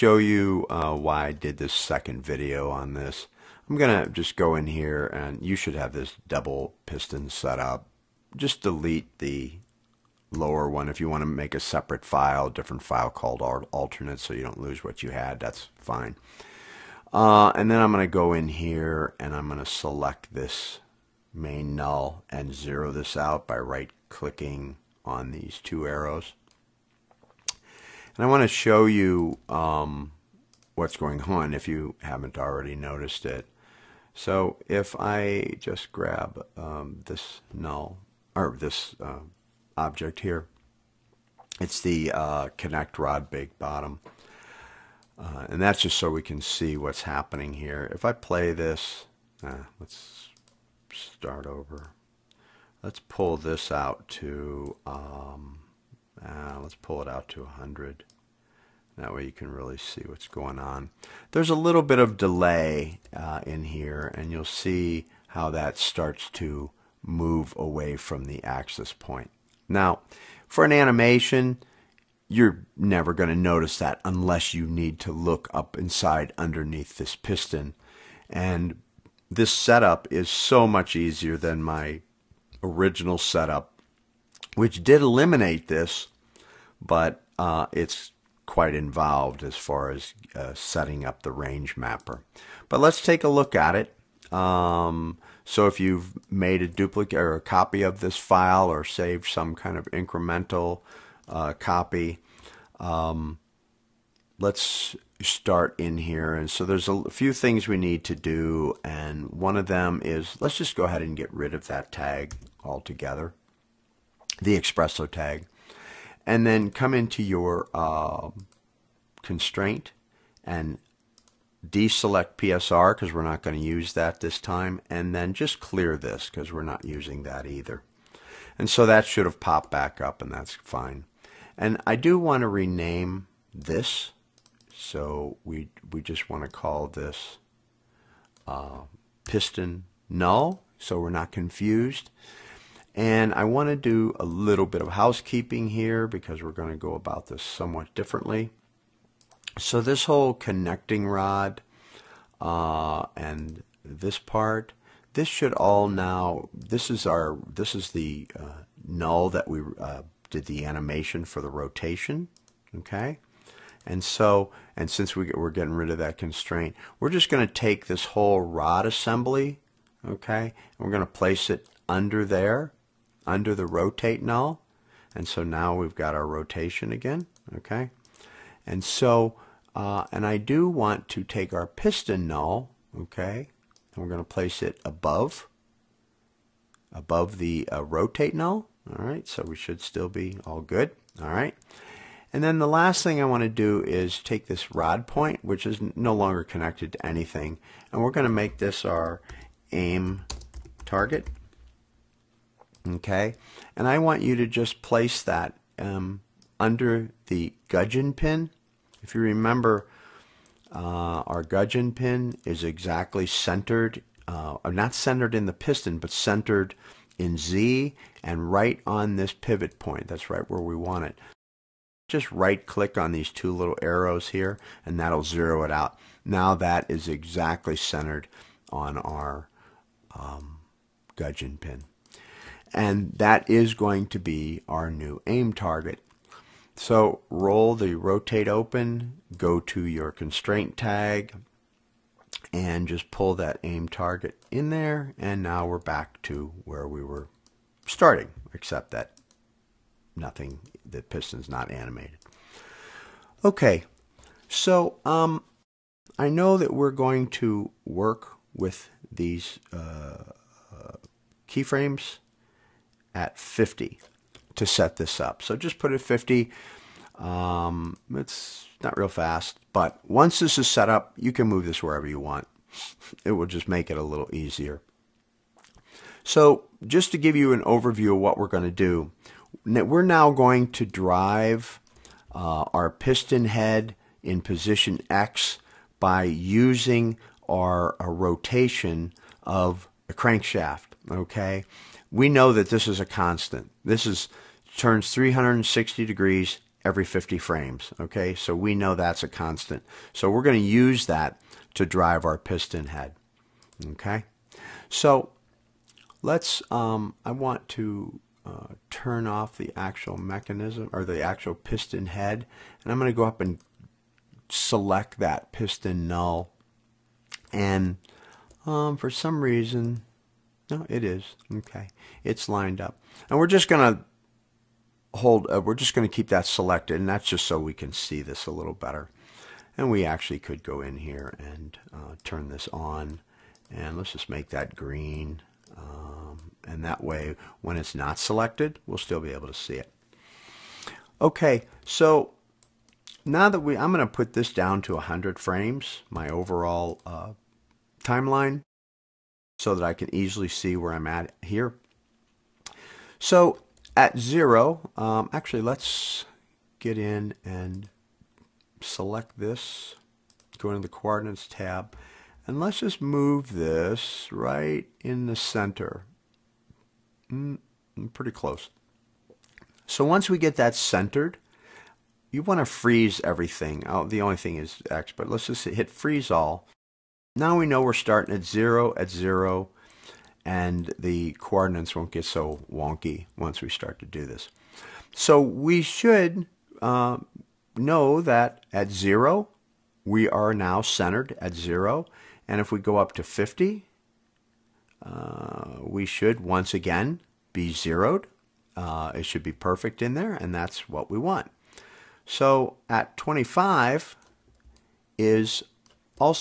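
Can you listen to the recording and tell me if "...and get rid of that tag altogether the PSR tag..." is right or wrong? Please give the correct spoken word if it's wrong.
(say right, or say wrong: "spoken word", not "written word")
wrong: "XPresso", not "PSR".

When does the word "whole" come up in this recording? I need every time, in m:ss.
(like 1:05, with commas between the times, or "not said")
2:30, 2:48.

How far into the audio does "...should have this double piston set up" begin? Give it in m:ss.
0:05.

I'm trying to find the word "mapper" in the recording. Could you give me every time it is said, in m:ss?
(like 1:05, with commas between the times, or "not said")
1:31.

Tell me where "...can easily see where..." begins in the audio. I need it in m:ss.
5:49.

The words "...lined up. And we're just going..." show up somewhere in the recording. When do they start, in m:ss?
5:22.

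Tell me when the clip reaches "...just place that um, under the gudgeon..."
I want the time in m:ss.
3:24.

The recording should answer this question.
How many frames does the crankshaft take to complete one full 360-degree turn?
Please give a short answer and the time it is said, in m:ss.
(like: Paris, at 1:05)
50, at 4:57.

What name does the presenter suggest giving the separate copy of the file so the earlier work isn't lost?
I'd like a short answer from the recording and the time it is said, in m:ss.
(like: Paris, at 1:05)
alternate, at 0:13.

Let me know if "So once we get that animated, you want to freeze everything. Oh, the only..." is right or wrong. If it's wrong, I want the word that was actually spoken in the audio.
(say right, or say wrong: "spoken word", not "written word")
wrong: "centered", not "animated".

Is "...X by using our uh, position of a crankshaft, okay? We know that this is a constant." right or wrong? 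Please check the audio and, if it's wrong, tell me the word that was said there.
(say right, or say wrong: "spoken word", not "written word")
wrong: "rotation", not "position".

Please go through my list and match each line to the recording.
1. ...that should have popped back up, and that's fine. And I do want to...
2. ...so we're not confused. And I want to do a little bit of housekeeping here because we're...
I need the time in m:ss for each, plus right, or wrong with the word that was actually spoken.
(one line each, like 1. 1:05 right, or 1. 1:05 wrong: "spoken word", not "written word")
1. 2:08 right
2. 2:20 right.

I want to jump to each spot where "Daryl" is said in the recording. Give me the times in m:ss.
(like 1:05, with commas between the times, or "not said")
not said.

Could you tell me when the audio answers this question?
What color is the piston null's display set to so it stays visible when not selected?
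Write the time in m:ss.
5:34.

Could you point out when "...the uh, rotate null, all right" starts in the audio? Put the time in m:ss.
3:07.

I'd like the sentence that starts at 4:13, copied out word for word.
Okay, so um, I know that we're going to work with these uh, uh, keyframes at 50 to set this up.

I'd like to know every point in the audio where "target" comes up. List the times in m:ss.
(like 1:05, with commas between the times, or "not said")
3:20, 3:55, 4:03.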